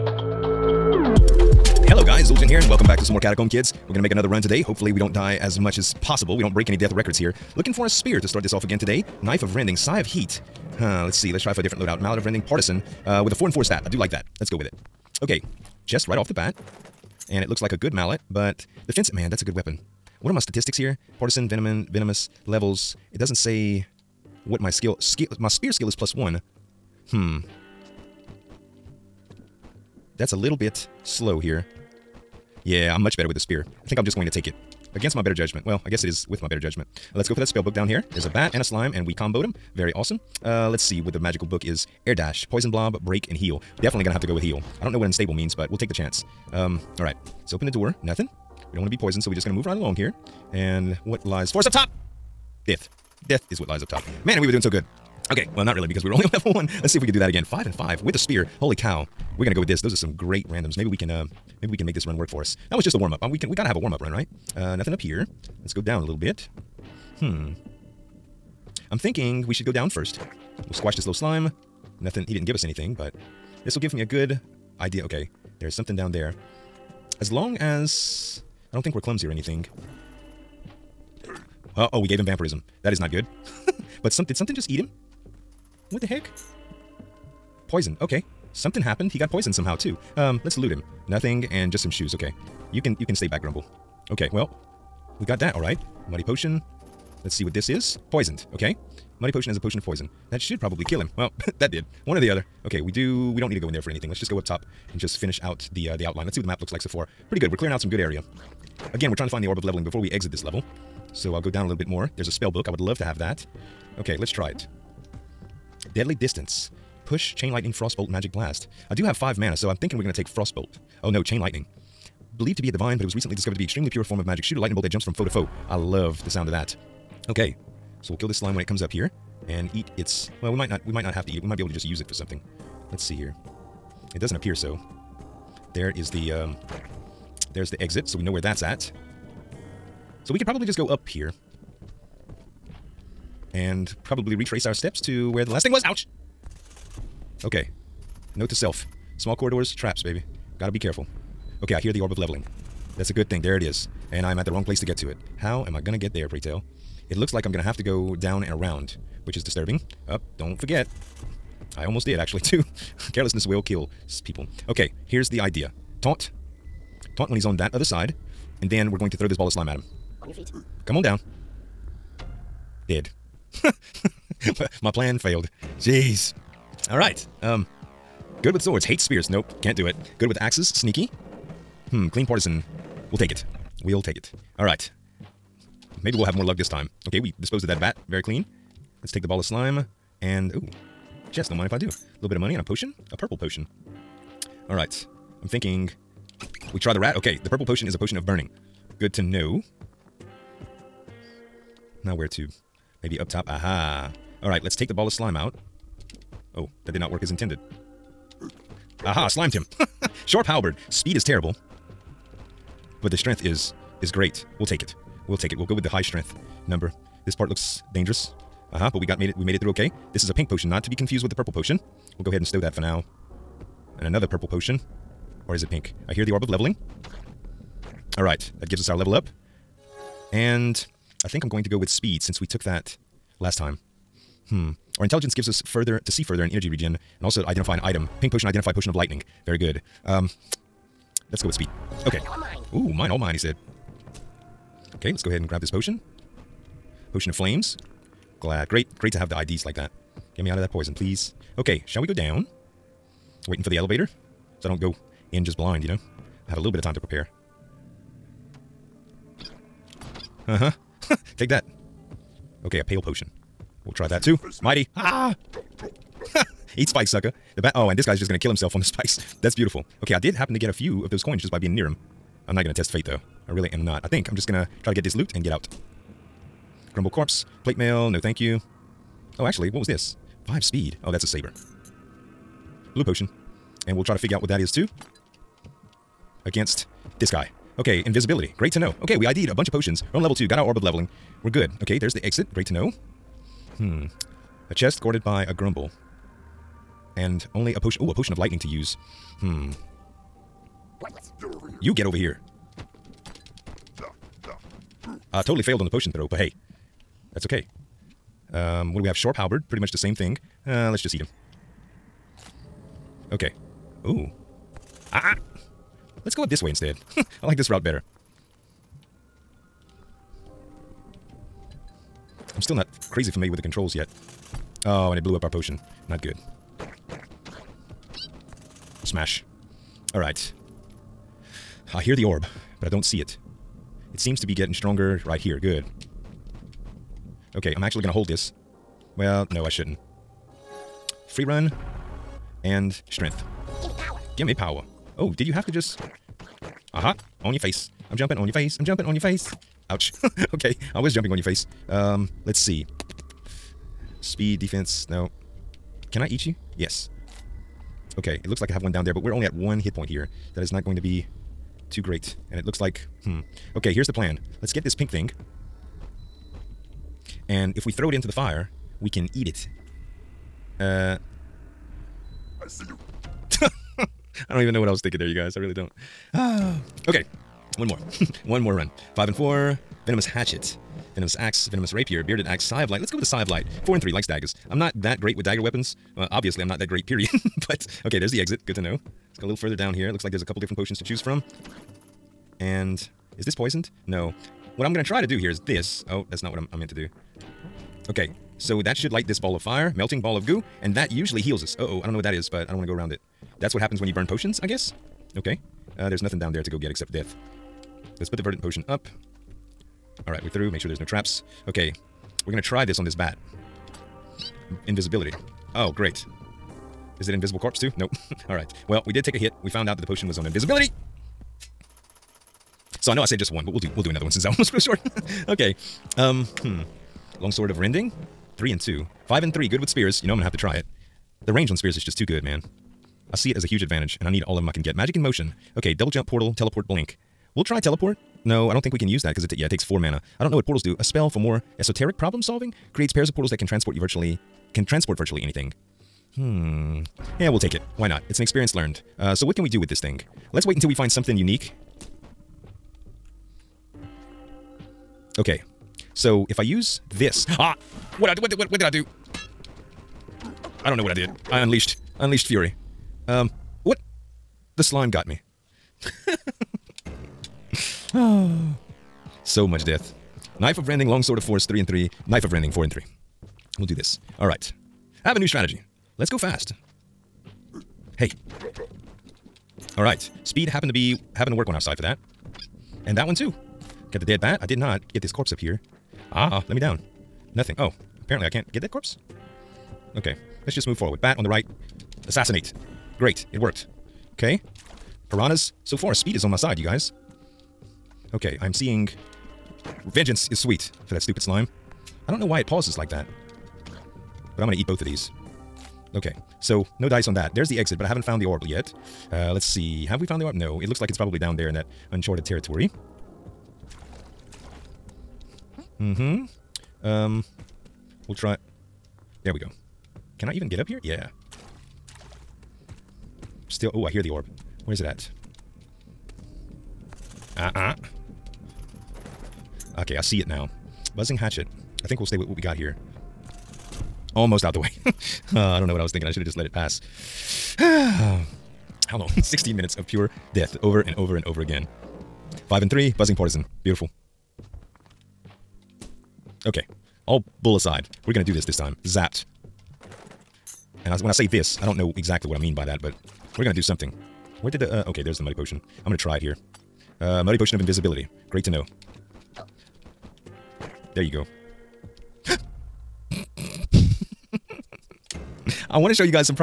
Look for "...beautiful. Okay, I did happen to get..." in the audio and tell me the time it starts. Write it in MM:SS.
04:29.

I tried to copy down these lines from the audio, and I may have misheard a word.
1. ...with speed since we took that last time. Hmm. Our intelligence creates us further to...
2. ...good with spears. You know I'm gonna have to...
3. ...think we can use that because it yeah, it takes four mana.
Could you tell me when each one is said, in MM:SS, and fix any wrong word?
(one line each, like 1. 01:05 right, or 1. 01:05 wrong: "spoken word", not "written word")
1. 03:51 wrong: "gives", not "creates"
2. 07:09 right
3. 07:18 right.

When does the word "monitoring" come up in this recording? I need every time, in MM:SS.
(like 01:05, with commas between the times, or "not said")
not said.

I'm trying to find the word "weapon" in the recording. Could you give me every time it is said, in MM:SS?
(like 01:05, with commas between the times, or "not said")
00:19, 06:25.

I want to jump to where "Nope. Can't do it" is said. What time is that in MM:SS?
02:59.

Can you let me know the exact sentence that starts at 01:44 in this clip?
Let's just go up top and just finish out the uh, the outline.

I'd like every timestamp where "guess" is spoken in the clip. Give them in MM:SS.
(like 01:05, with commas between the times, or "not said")
00:35, 06:44.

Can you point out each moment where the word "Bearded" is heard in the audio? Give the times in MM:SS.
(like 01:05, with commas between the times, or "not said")
06:22.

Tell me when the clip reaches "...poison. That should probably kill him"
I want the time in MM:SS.
01:39.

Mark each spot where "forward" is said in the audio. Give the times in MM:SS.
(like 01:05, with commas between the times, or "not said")
08:10.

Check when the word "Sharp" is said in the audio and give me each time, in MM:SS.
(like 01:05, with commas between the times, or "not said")
03:30, 05:09.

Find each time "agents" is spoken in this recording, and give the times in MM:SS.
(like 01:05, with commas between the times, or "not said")
not said.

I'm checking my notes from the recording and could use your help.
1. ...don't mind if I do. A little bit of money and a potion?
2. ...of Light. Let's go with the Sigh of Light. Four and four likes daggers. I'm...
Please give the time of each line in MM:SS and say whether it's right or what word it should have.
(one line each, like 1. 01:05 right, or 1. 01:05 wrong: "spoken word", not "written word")
1. 03:11 right
2. 06:22 wrong: "three", not "four".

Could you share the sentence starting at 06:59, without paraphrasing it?
We found out that the potion was on invisibility.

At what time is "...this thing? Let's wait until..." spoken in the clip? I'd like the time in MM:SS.
07:29.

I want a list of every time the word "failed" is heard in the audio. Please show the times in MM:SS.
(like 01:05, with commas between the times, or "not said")
02:55, 05:05.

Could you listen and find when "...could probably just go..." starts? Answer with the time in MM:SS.
02:20.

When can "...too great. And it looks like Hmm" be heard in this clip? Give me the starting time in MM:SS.
06:01.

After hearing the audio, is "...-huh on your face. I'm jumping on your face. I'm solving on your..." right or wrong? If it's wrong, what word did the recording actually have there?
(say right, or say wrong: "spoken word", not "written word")
wrong: "jumping", not "solving".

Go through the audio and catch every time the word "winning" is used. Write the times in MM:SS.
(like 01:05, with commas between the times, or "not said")
not said.